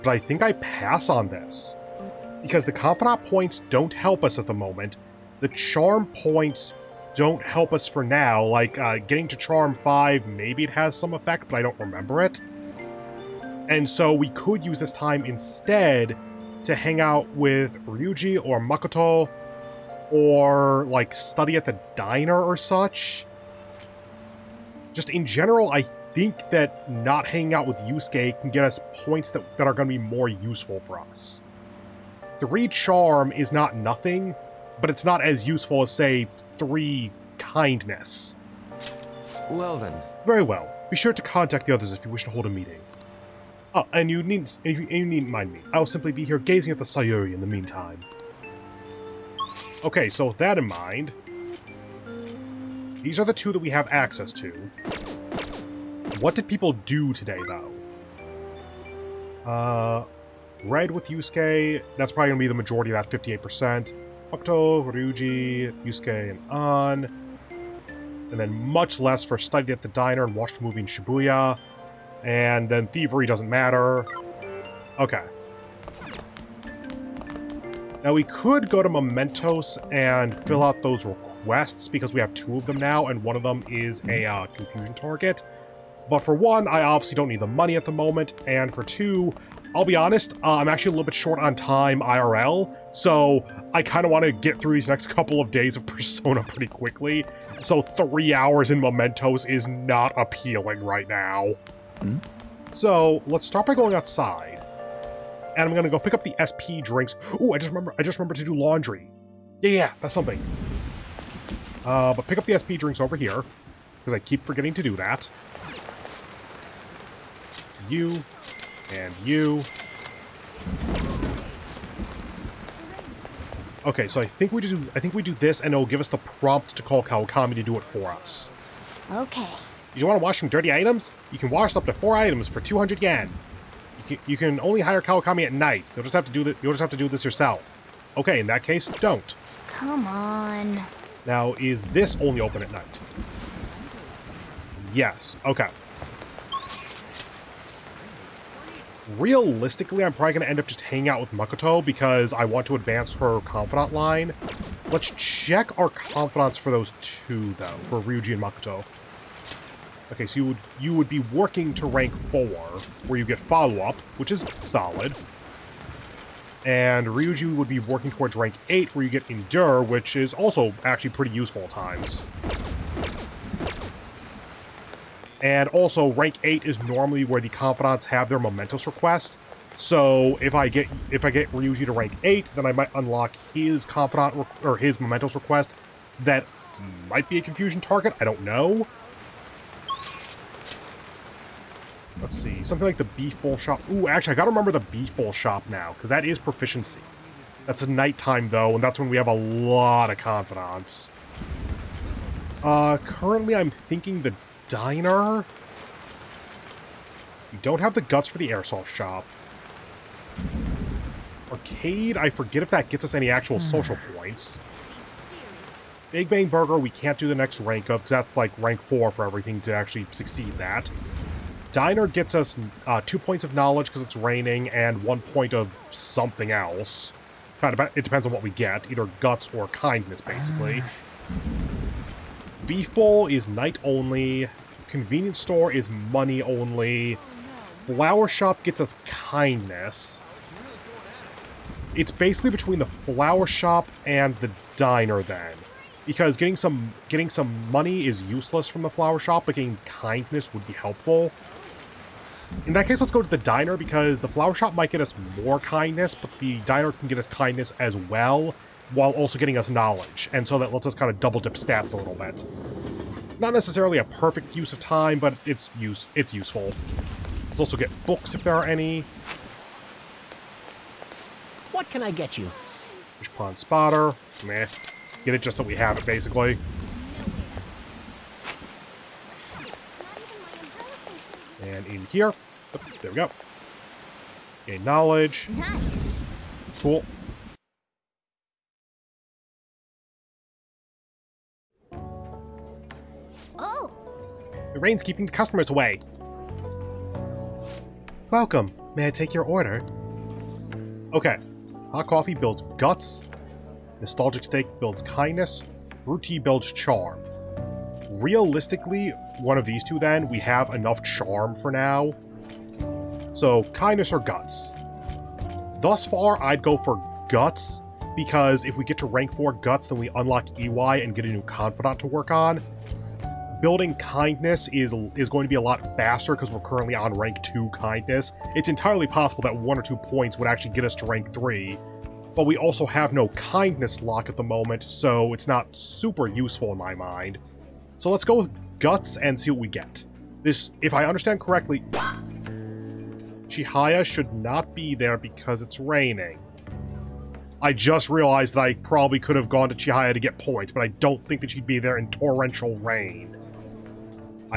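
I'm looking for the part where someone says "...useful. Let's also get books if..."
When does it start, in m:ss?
4:26.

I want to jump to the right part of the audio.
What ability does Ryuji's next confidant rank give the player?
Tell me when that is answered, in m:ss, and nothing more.
2:49.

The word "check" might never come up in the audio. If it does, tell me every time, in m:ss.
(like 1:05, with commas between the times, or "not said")
2:35.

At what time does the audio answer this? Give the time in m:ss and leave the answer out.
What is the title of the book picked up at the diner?
4:33.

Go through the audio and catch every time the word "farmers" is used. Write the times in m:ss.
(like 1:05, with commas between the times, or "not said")
not said.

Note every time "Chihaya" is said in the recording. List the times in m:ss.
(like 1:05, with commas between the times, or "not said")
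5:43, 5:49.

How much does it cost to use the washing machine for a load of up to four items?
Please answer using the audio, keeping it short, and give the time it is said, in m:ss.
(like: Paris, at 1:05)
200 yen, at 2:12.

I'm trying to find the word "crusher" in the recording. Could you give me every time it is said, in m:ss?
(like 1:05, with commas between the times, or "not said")
not said.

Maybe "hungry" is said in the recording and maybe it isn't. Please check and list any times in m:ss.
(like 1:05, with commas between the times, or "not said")
not said.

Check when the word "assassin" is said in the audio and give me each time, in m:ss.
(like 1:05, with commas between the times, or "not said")
not said.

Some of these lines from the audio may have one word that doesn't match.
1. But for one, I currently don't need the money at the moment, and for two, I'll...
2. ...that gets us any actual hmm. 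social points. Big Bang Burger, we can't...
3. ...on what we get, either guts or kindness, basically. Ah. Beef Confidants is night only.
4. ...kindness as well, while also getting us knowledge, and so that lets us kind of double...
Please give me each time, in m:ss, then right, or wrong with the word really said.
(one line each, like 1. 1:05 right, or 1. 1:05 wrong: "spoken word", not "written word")
1. 1:26 wrong: "obviously", not "currently"
2. 3:32 right
3. 3:48 wrong: "Bowl", not "Confidants"
4. 4:17 right.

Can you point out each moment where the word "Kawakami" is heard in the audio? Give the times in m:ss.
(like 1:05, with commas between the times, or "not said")
2:07, 2:15.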